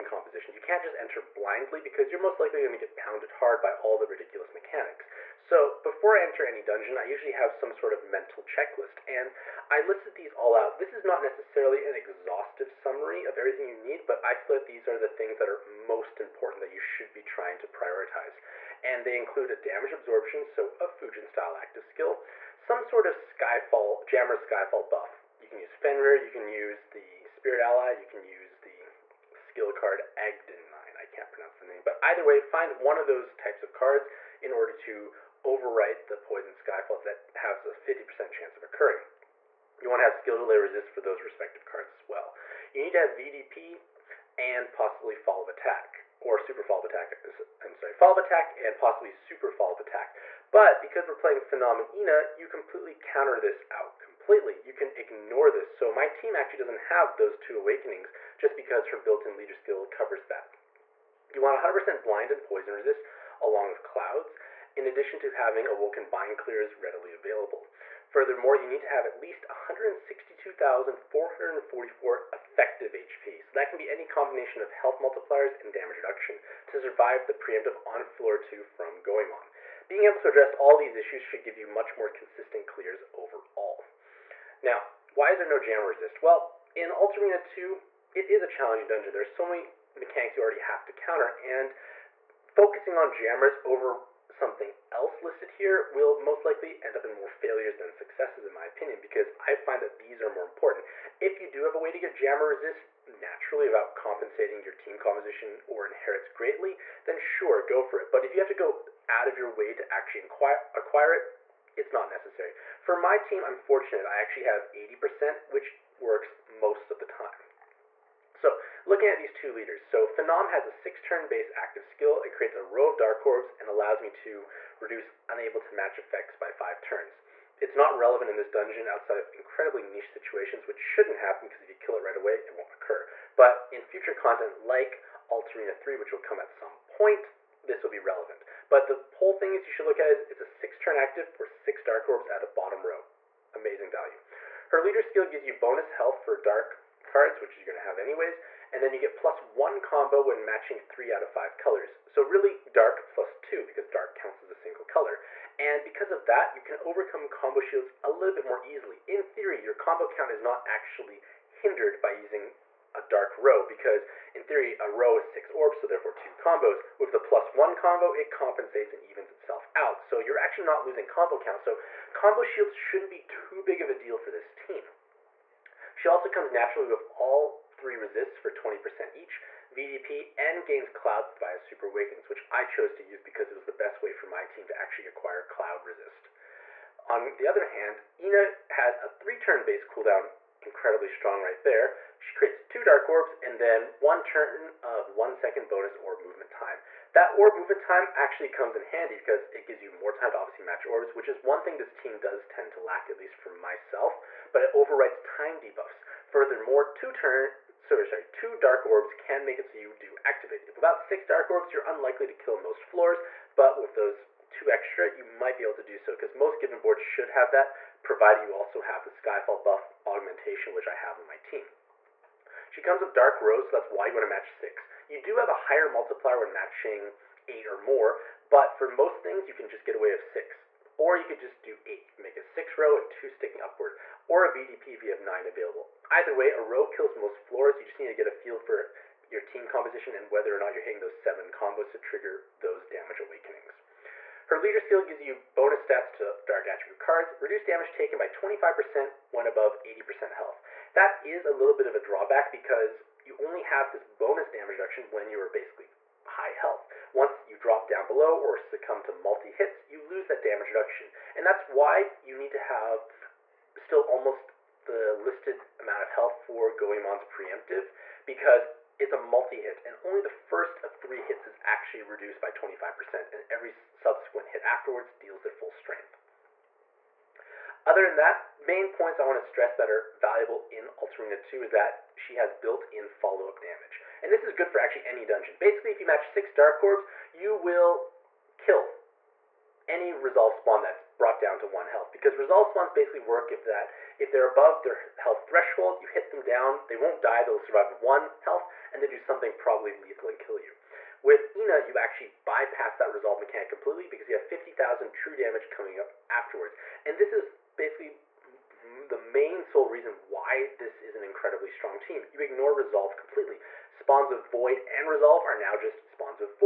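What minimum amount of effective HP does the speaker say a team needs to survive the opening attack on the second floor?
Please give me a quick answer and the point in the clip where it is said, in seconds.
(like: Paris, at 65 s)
162,444, at 69 s.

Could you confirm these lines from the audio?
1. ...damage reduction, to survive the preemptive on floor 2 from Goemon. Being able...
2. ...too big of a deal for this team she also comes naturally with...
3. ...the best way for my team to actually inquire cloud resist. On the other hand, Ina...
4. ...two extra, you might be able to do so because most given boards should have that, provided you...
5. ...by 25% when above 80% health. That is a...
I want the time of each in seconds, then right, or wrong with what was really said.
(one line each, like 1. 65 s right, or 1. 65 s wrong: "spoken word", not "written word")
1. 75 s right
2. 173 s right
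3. 183 s wrong: "acquire", not "inquire"
4. 214 s right
5. 248 s right.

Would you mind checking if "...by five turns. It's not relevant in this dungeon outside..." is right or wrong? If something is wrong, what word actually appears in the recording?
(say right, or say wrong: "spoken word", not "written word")
right.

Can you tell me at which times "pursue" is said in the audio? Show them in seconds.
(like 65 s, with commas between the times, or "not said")
not said.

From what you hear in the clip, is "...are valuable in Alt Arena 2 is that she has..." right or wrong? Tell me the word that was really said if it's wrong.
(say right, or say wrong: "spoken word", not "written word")
right.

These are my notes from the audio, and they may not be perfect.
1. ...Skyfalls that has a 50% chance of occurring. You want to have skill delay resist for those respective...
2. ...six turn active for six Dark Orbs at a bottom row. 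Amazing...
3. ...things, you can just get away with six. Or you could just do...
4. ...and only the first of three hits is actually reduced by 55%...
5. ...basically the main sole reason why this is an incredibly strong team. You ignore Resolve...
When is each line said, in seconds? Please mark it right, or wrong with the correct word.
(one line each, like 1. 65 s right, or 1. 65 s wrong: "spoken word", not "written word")
1. 36 s right
2. 140 s right
3. 229 s right
4. 269 s wrong: "25", not "55"
5. 307 s right.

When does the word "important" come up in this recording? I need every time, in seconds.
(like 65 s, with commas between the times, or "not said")
16 s, 100 s.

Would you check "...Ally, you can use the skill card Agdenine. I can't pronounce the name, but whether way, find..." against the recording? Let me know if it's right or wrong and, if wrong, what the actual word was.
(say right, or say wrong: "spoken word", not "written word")
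wrong: "either", not "whether".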